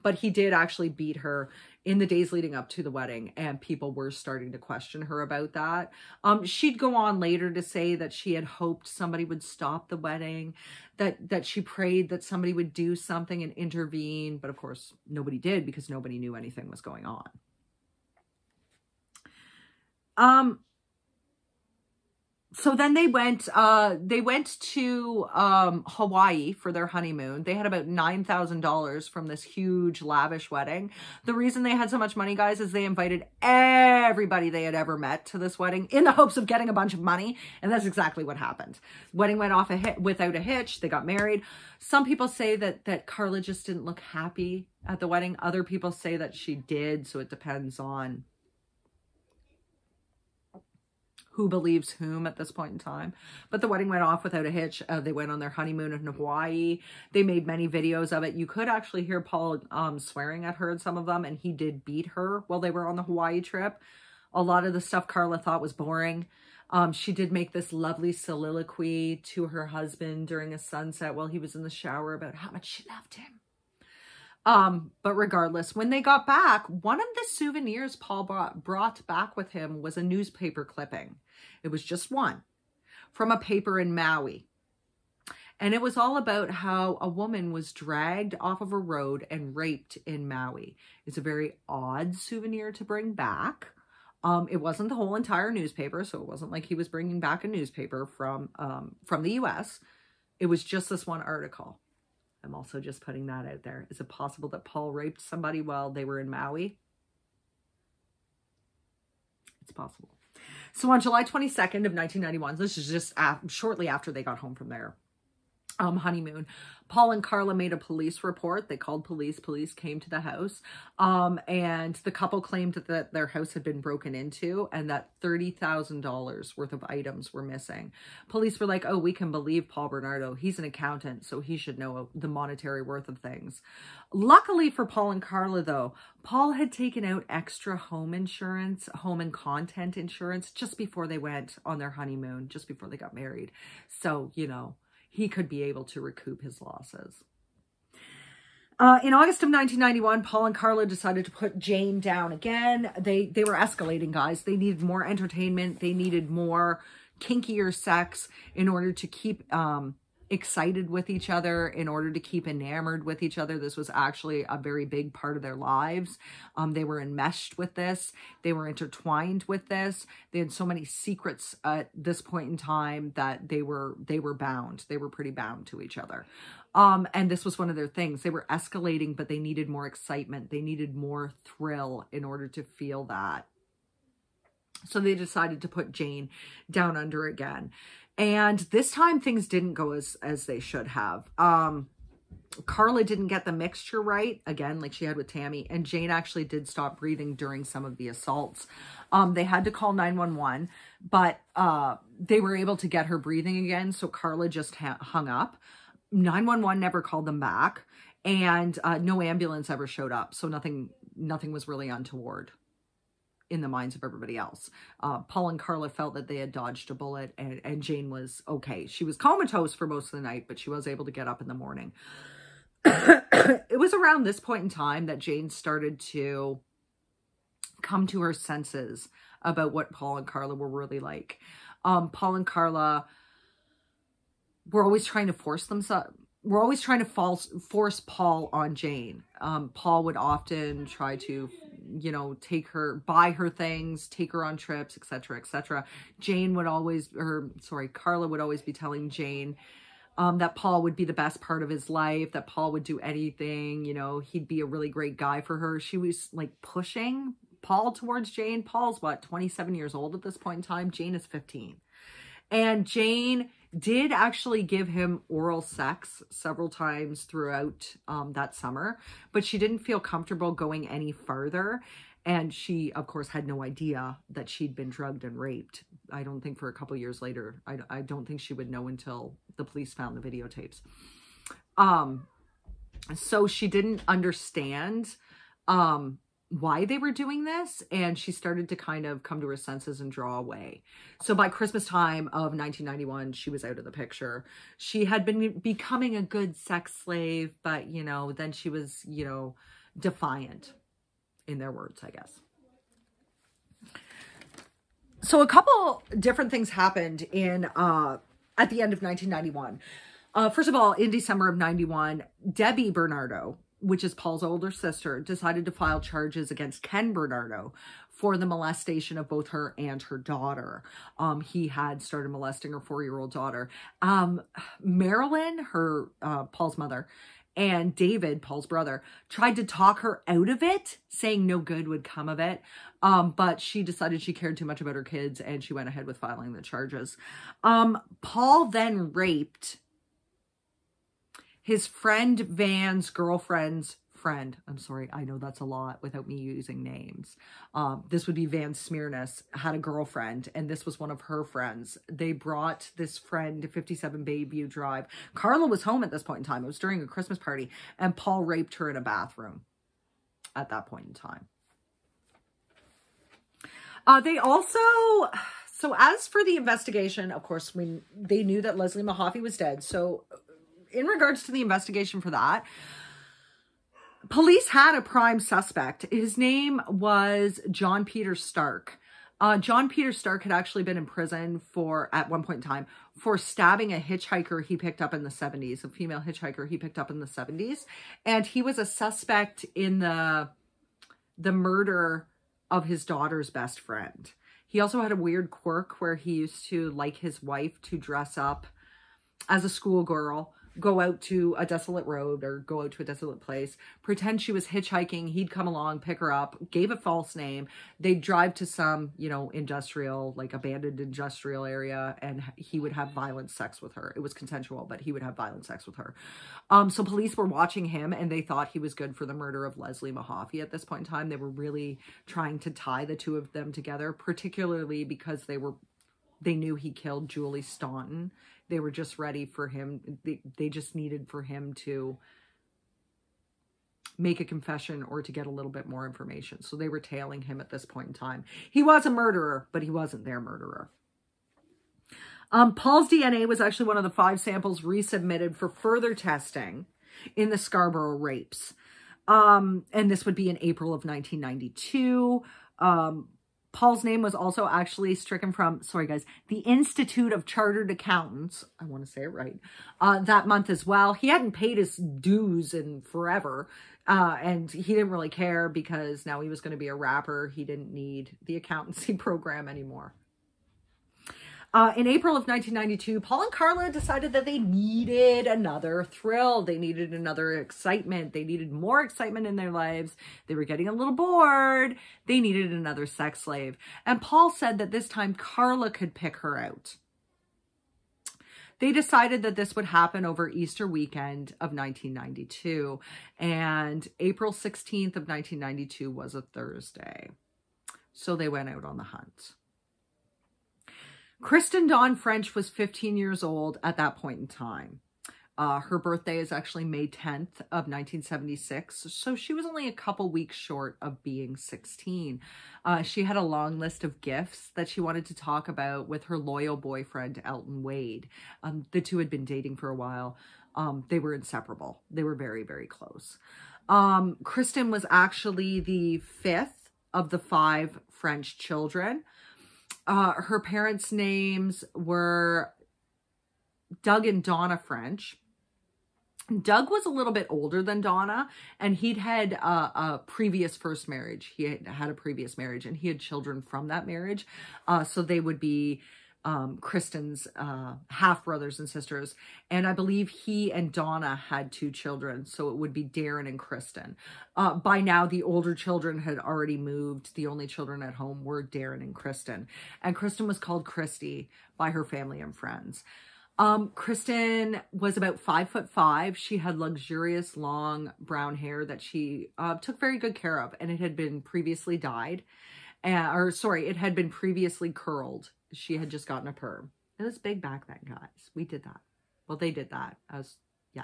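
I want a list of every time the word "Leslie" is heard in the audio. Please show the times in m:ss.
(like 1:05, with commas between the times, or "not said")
6:08, 6:59.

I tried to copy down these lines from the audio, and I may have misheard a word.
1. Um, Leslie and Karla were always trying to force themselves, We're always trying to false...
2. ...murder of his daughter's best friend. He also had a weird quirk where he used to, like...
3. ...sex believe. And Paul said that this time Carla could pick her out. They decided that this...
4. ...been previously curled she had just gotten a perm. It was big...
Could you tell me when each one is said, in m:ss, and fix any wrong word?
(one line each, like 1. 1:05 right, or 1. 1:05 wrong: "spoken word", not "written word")
1. 3:51 wrong: "Paul", not "Leslie"
2. 6:31 right
3. 8:03 wrong: "slave", not "believe"
4. 9:34 right.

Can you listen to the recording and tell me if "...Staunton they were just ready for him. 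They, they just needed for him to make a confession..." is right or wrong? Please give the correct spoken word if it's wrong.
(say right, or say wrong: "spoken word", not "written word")
right.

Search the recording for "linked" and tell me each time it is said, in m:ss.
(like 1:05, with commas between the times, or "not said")
not said.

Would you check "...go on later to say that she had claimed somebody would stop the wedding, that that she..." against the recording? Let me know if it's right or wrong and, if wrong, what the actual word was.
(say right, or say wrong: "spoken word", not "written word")
wrong: "hoped", not "claimed".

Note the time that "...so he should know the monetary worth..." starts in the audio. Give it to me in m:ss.
2:11.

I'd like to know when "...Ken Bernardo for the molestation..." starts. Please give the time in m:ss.
5:16.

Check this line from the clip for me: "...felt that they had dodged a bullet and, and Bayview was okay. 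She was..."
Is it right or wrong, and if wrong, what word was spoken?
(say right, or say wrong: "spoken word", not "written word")
wrong: "Jane", not "Bayview".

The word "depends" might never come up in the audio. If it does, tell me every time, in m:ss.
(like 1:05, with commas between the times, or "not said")
0:47.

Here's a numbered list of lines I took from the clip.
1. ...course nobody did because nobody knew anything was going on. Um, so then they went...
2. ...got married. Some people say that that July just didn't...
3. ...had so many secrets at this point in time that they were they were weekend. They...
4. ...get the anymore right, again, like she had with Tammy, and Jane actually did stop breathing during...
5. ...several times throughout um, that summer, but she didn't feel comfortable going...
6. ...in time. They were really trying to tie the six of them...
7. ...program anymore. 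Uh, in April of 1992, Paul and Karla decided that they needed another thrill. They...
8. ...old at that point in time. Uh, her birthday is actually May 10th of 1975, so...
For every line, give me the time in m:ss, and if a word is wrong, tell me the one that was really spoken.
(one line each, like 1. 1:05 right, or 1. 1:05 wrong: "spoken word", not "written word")
1. 0:14 right
2. 0:40 wrong: "Karla", not "July"
3. 2:50 wrong: "bound", not "weekend"
4. 3:13 wrong: "mixture", not "anymore"
5. 4:26 right
6. 7:01 wrong: "two", not "six"
7. 7:49 right
8. 8:23 wrong: "1976", not "1975".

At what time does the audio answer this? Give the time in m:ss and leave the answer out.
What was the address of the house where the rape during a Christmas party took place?
5:53.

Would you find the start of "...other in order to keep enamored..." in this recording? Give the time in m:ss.
2:41.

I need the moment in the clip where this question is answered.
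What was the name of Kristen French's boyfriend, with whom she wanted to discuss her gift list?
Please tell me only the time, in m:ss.
8:37.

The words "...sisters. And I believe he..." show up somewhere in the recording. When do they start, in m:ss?
9:08.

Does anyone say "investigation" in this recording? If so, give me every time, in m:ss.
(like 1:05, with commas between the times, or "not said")
6:06, 6:11.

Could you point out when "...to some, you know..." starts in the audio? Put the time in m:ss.
6:48.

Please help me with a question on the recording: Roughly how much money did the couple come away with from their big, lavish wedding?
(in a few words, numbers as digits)
$9,000.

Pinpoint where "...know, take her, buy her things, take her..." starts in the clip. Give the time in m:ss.
4:02.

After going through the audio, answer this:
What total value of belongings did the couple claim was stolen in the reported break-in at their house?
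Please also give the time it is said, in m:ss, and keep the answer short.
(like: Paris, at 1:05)
$30,000, at 2:05.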